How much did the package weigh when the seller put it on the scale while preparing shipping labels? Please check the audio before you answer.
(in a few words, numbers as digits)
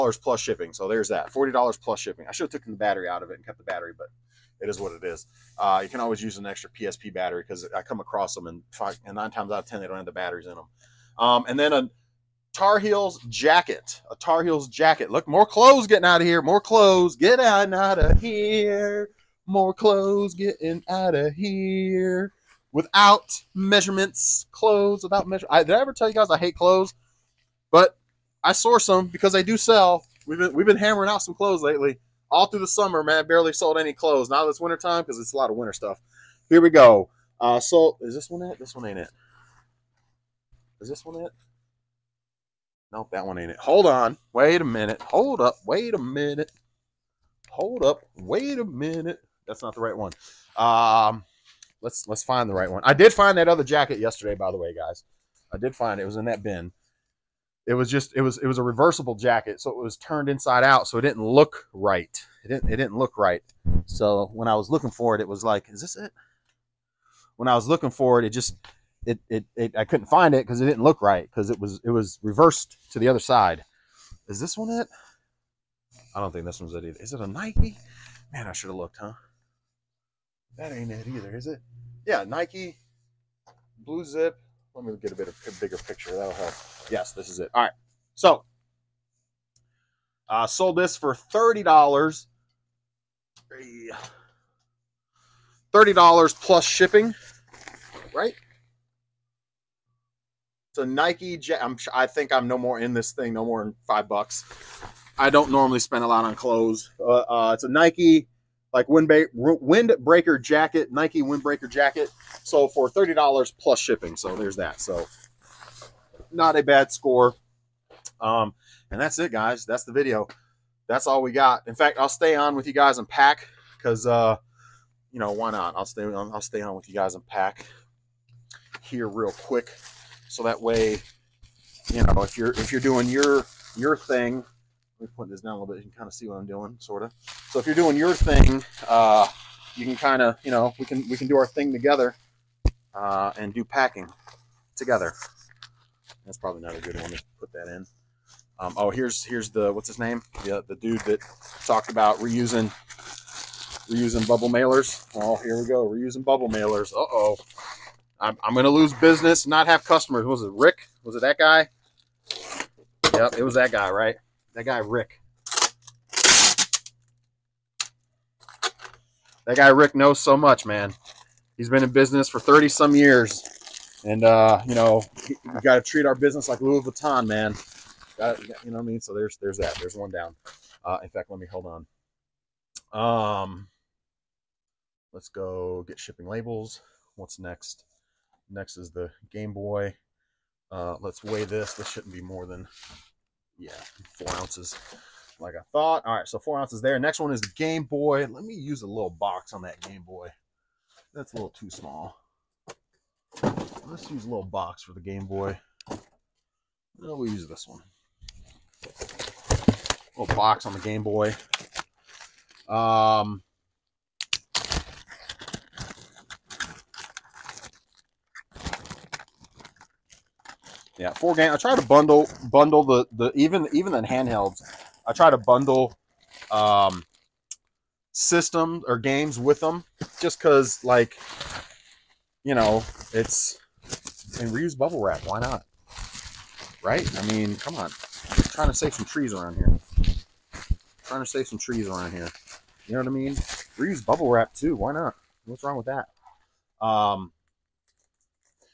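4 ounces.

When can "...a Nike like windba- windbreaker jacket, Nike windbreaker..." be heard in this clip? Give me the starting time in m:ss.
1:47.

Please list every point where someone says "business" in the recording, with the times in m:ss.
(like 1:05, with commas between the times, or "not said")
2:38, 2:51, 2:56.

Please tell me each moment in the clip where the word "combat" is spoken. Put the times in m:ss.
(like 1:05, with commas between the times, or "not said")
not said.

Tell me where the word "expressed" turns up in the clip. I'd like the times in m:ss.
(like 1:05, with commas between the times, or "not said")
not said.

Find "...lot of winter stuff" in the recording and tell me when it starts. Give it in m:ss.
0:35.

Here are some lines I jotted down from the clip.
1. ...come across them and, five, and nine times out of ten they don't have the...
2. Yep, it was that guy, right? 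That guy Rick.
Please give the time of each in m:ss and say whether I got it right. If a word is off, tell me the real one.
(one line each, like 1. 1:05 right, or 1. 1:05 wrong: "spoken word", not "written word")
1. 0:07 right
2. 2:43 right.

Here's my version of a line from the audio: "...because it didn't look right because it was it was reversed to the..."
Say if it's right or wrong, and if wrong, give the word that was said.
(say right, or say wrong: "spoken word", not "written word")
right.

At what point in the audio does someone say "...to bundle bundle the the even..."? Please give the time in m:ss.
3:41.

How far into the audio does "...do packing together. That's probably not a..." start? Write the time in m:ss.
2:23.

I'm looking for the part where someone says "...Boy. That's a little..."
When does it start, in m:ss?
3:20.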